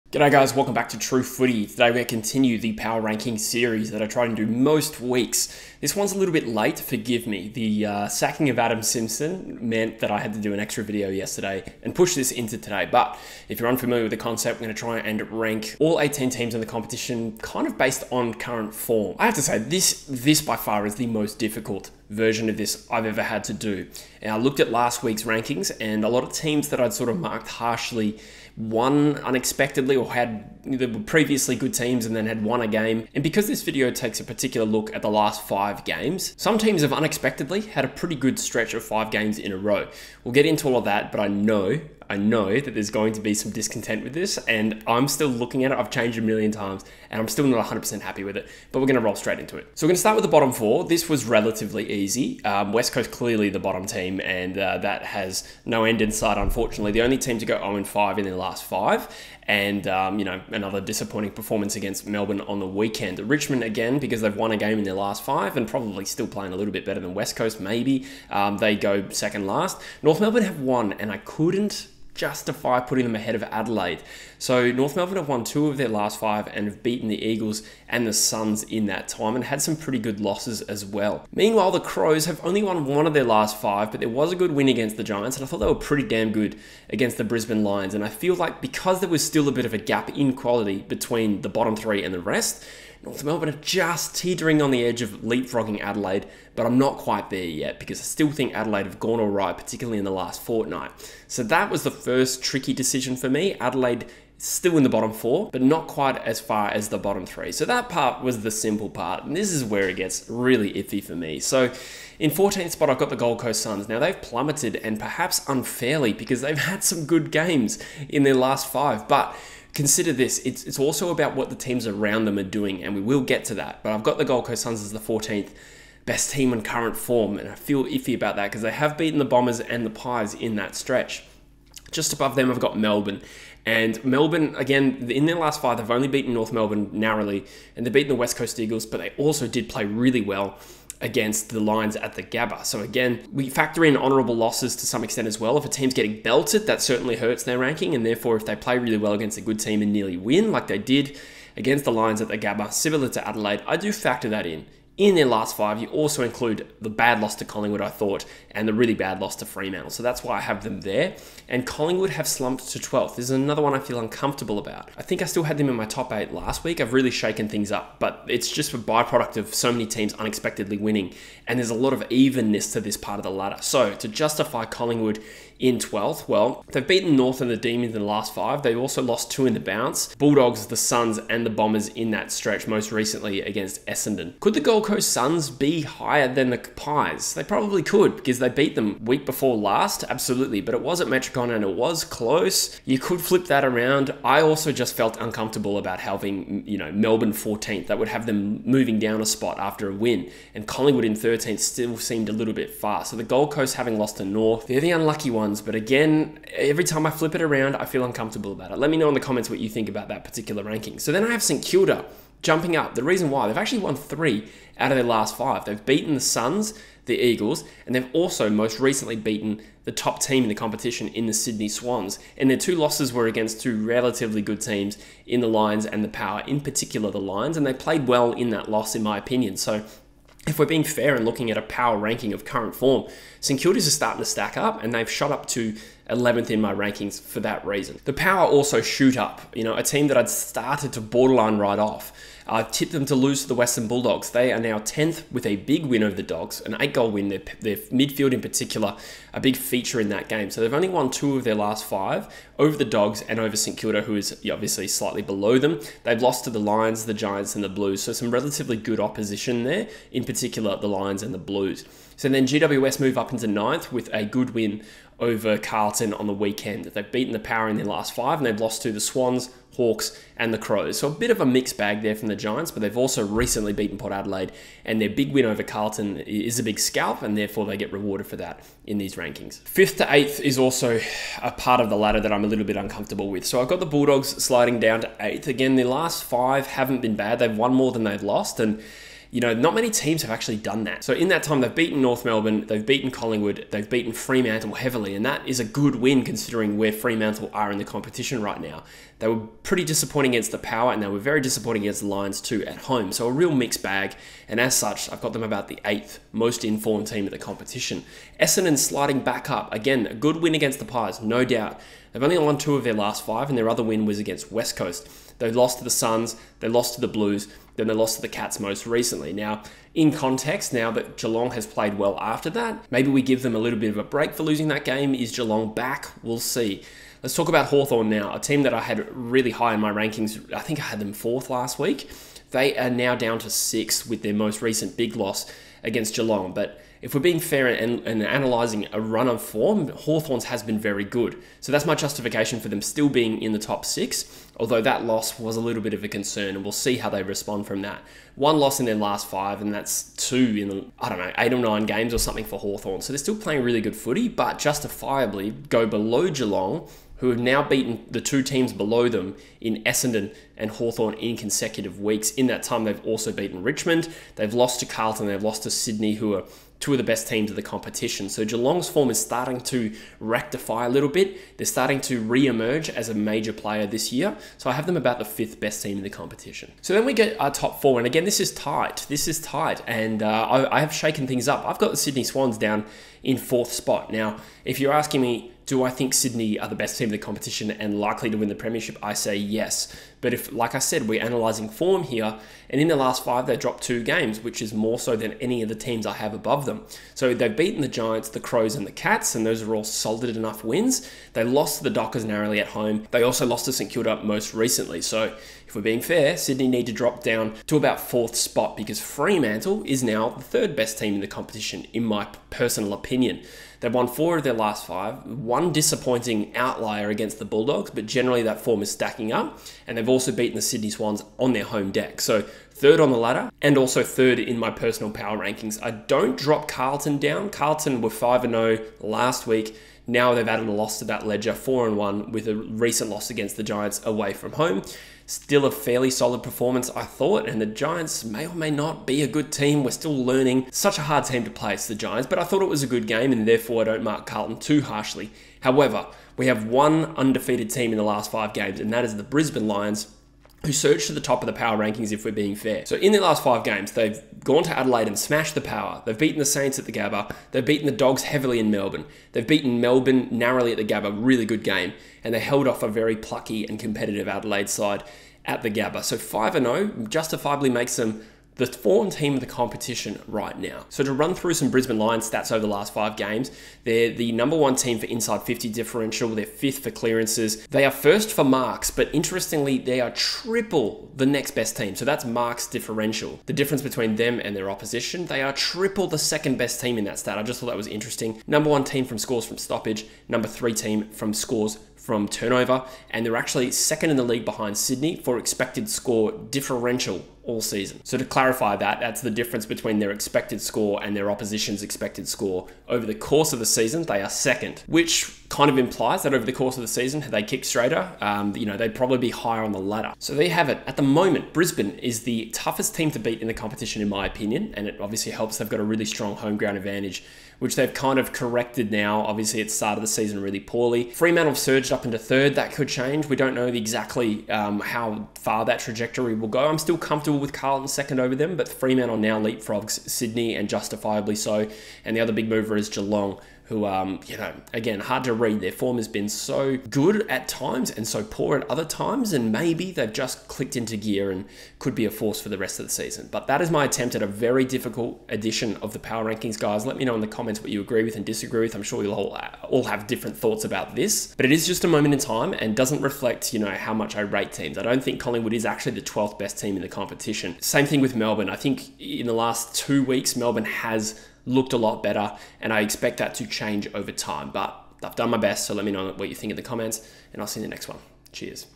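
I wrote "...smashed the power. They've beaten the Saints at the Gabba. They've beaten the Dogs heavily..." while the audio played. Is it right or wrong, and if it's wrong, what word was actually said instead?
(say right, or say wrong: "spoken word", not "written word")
right.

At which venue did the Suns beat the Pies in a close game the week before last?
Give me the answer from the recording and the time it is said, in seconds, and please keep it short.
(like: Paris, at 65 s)
Metricon, at 191 s.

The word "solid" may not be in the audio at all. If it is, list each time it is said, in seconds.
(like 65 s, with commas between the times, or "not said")
399 s, 436 s.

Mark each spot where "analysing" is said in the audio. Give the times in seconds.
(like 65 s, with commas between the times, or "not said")
338 s, 391 s.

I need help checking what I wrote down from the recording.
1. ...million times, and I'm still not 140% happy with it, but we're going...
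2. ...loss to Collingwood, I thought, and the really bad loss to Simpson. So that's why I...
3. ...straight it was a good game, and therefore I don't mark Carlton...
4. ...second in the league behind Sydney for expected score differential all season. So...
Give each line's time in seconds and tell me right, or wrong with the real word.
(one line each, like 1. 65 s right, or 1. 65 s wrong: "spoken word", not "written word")
1. 46 s wrong: "100", not "140"
2. 157 s wrong: "Fremantle", not "Simpson"
3. 442 s wrong: "thought", not "straight"
4. 493 s right.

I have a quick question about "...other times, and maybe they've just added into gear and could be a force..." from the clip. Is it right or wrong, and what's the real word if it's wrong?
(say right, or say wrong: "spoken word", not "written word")
wrong: "clicked", not "added".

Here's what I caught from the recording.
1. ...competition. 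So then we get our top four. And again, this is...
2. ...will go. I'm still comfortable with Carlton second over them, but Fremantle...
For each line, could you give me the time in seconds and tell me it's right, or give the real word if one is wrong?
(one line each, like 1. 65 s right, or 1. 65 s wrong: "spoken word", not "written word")
1. 376 s right
2. 526 s right.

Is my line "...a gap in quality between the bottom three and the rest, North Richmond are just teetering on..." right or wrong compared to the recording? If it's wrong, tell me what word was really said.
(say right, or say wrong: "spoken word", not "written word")
wrong: "Melbourne", not "Richmond".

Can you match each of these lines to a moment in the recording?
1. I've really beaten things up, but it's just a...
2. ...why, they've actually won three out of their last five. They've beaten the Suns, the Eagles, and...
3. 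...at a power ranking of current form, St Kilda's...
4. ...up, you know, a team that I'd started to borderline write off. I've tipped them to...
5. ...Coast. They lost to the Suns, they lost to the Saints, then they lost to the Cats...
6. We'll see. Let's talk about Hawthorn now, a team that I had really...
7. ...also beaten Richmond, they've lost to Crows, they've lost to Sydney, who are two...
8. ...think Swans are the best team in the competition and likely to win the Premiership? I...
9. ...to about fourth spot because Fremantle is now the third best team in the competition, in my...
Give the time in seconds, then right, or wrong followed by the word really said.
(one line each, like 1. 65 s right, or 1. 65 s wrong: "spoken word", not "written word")
1. 166 s wrong: "shaken", not "beaten"
2. 213 s right
3. 231 s right
4. 239 s right
5. 314 s wrong: "Blues", not "Saints"
6. 326 s right
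7. 363 s wrong: "Carlton", not "Crows"
8. 385 s wrong: "Sydney", not "Swans"
9. 407 s right.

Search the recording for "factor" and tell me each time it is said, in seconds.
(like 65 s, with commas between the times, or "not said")
143 s, 153 s.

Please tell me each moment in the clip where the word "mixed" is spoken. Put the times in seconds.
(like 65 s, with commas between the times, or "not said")
271 s, 303 s.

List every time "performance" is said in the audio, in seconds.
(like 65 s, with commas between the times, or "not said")
61 s, 436 s.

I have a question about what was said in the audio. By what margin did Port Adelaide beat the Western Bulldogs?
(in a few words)
8 goals.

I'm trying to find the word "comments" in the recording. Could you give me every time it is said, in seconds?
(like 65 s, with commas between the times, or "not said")
209 s, 547 s, 566 s.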